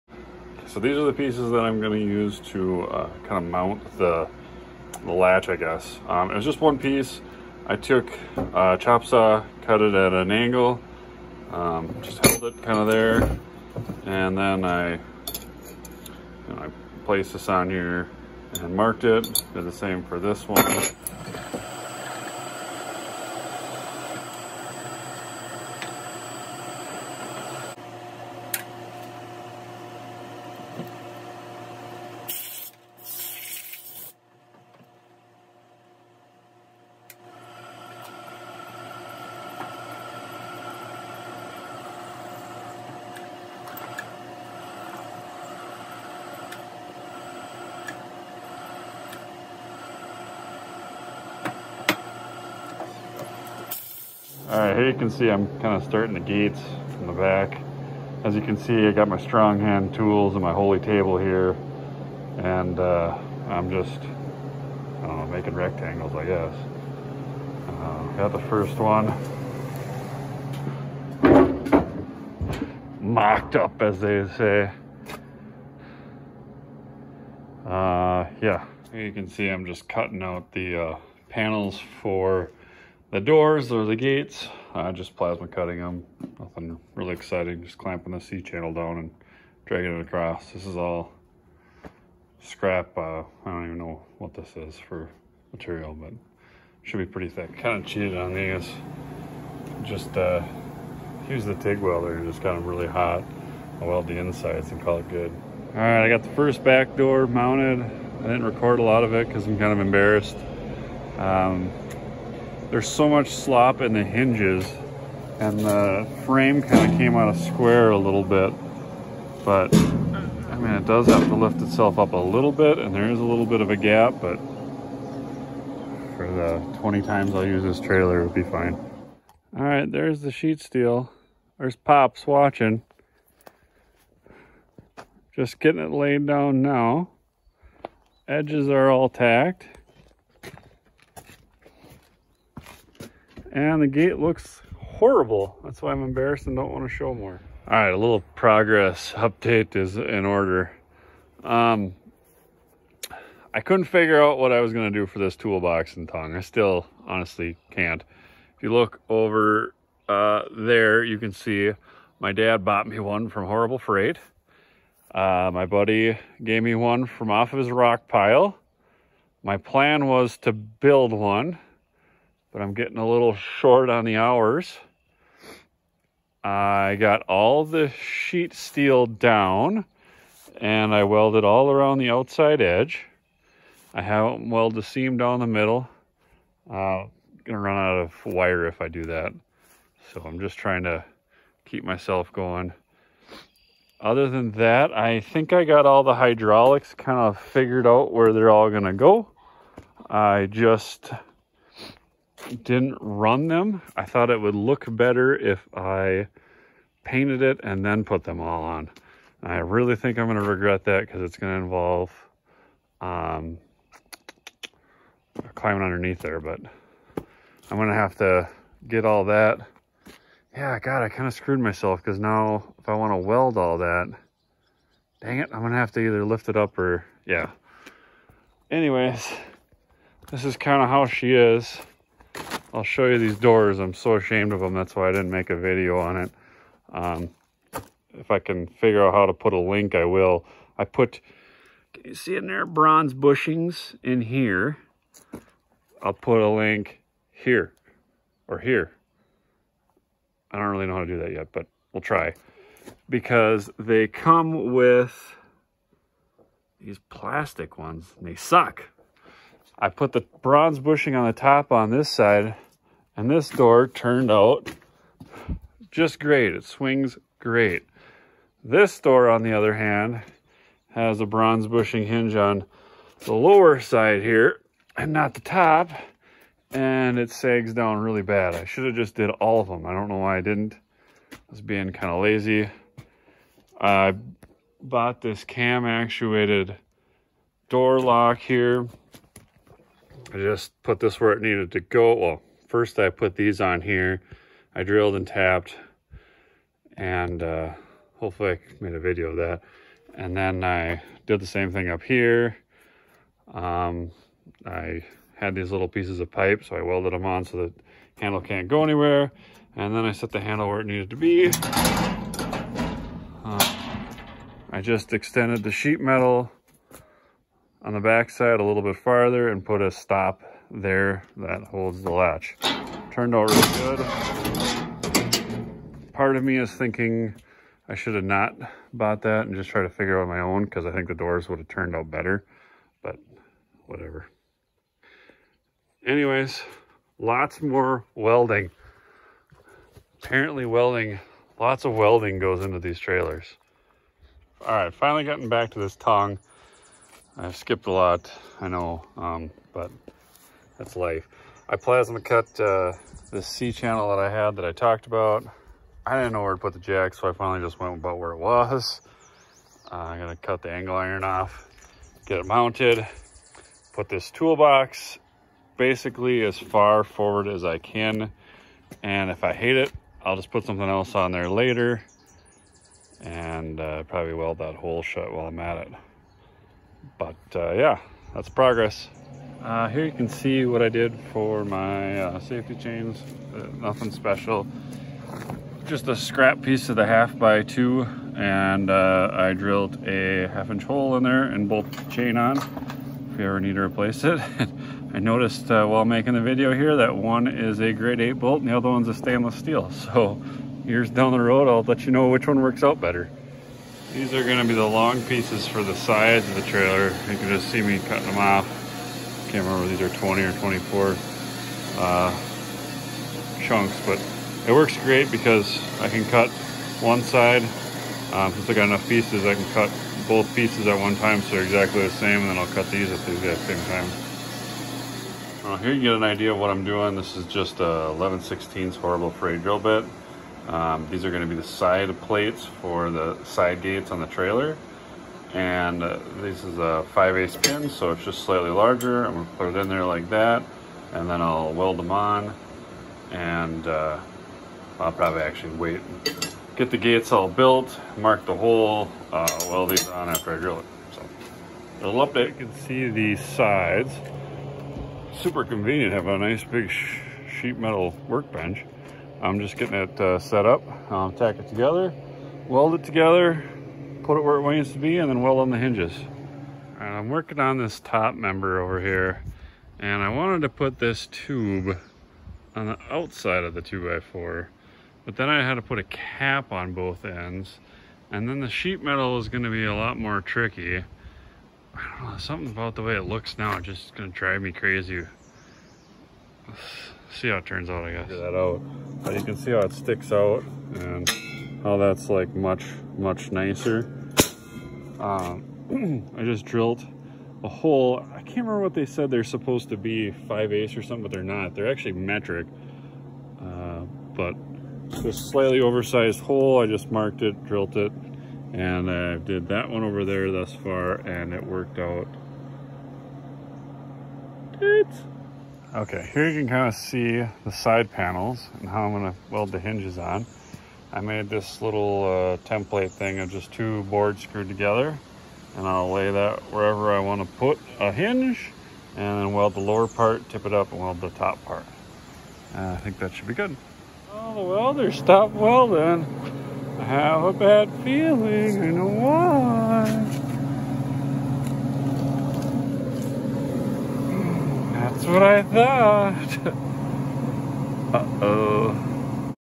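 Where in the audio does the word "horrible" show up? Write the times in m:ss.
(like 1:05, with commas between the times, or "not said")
2:24, 2:43, 7:08.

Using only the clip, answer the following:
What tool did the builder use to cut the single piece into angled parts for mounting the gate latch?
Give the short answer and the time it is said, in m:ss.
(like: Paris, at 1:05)
chop saw, at 0:08.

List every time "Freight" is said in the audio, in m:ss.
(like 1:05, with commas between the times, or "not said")
2:43, 7:09.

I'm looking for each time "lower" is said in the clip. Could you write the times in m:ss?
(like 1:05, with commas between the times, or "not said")
4:33, 8:49.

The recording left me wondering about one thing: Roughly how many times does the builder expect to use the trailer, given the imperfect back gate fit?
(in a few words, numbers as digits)
20.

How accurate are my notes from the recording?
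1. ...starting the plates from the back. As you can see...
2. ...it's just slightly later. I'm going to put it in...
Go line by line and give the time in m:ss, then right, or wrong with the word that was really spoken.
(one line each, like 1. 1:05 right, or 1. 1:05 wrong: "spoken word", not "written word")
1. 0:55 wrong: "gates", not "plates"
2. 7:18 wrong: "larger", not "later".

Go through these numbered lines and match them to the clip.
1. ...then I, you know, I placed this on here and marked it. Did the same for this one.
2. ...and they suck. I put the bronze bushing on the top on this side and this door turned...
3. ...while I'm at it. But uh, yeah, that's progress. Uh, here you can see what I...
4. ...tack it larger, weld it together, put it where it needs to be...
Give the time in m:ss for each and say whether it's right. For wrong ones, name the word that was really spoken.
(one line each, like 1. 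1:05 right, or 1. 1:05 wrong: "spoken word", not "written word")
1. 0:14 right
2. 4:18 right
3. 6:15 right
4. 7:41 wrong: "together", not "larger".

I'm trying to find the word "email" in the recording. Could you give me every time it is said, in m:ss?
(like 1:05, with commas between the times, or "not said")
not said.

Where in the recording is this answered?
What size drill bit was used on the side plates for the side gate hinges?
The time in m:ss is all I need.
7:08.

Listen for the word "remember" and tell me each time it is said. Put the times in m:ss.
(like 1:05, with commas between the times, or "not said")
6:49, 8:18.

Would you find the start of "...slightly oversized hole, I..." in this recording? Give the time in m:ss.
8:25.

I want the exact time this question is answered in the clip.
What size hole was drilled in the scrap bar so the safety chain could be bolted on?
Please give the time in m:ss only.
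6:30.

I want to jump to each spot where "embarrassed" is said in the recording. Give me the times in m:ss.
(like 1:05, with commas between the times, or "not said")
1:49, 2:26.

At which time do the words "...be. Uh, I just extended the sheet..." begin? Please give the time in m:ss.
5:11.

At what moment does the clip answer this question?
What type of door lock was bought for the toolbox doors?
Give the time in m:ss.
4:45.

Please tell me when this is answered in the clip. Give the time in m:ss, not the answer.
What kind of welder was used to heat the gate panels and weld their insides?
1:41.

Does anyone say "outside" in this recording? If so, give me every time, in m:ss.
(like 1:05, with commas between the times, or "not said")
3:02, 7:53.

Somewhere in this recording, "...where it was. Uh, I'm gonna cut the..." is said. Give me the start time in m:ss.
5:58.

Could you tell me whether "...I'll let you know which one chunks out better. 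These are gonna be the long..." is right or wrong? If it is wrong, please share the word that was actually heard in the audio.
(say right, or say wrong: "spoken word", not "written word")
wrong: "works", not "chunks".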